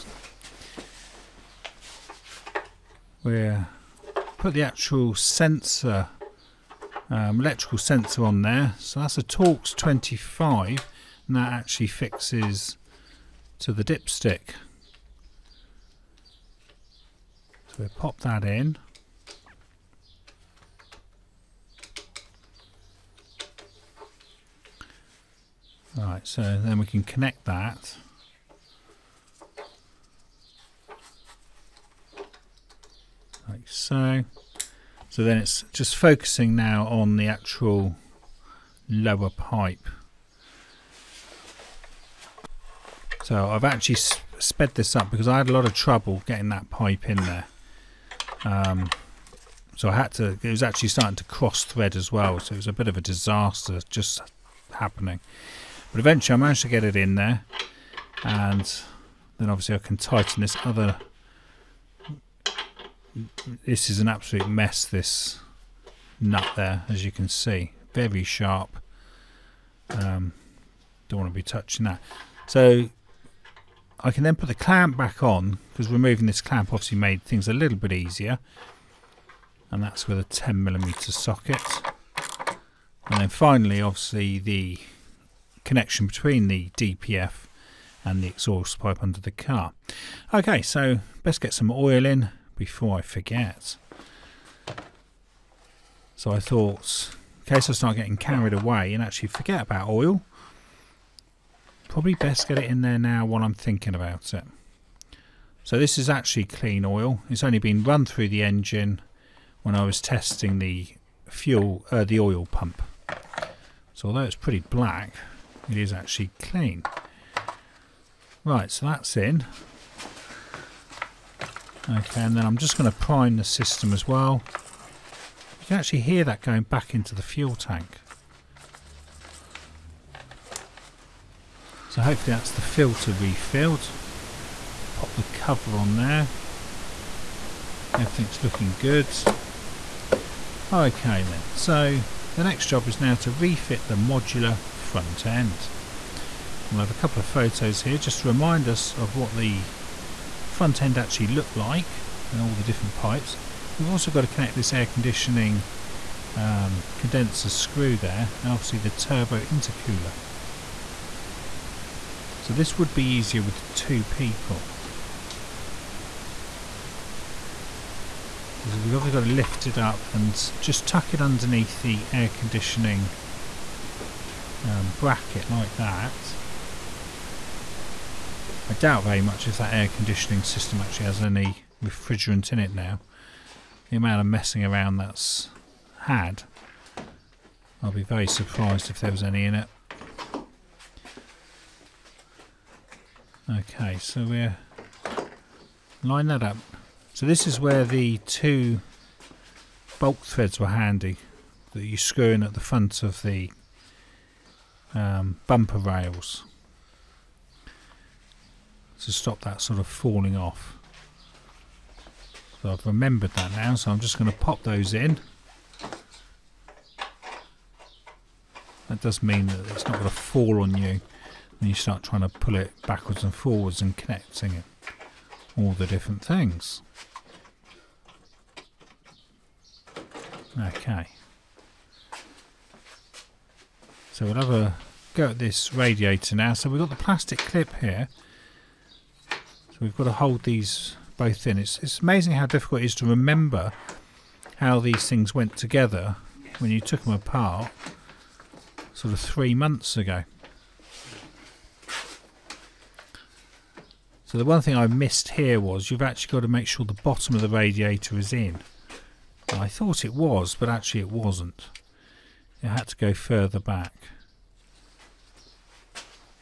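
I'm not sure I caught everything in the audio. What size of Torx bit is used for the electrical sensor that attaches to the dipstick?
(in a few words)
Torx 25.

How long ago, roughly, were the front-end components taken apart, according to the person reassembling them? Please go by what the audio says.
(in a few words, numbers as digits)
3 months.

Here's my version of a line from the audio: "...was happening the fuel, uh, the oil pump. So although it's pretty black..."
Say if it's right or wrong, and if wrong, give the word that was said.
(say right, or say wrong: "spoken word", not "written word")
wrong: "testing", not "happening".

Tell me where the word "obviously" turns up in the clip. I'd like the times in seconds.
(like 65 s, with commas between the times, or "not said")
59 s, 76 s, 83 s, 158 s, 168 s.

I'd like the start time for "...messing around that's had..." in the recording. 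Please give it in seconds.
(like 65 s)
184 s.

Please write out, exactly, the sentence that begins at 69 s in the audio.
Um, don't want to be touching that.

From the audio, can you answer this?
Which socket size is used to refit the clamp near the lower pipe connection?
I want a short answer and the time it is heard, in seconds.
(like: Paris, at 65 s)
10 millimeter, at 80 s.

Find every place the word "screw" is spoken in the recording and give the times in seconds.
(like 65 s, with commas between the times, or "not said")
157 s, 201 s.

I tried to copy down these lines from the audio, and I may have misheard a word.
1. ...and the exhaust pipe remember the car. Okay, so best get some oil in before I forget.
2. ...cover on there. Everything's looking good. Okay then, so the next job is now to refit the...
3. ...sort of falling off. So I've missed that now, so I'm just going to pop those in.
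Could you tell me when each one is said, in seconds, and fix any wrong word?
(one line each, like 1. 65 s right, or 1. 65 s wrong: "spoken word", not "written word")
1. 88 s wrong: "under", not "remember"
2. 135 s right
3. 209 s wrong: "remembered", not "missed".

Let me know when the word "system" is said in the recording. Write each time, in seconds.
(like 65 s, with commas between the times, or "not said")
123 s, 180 s.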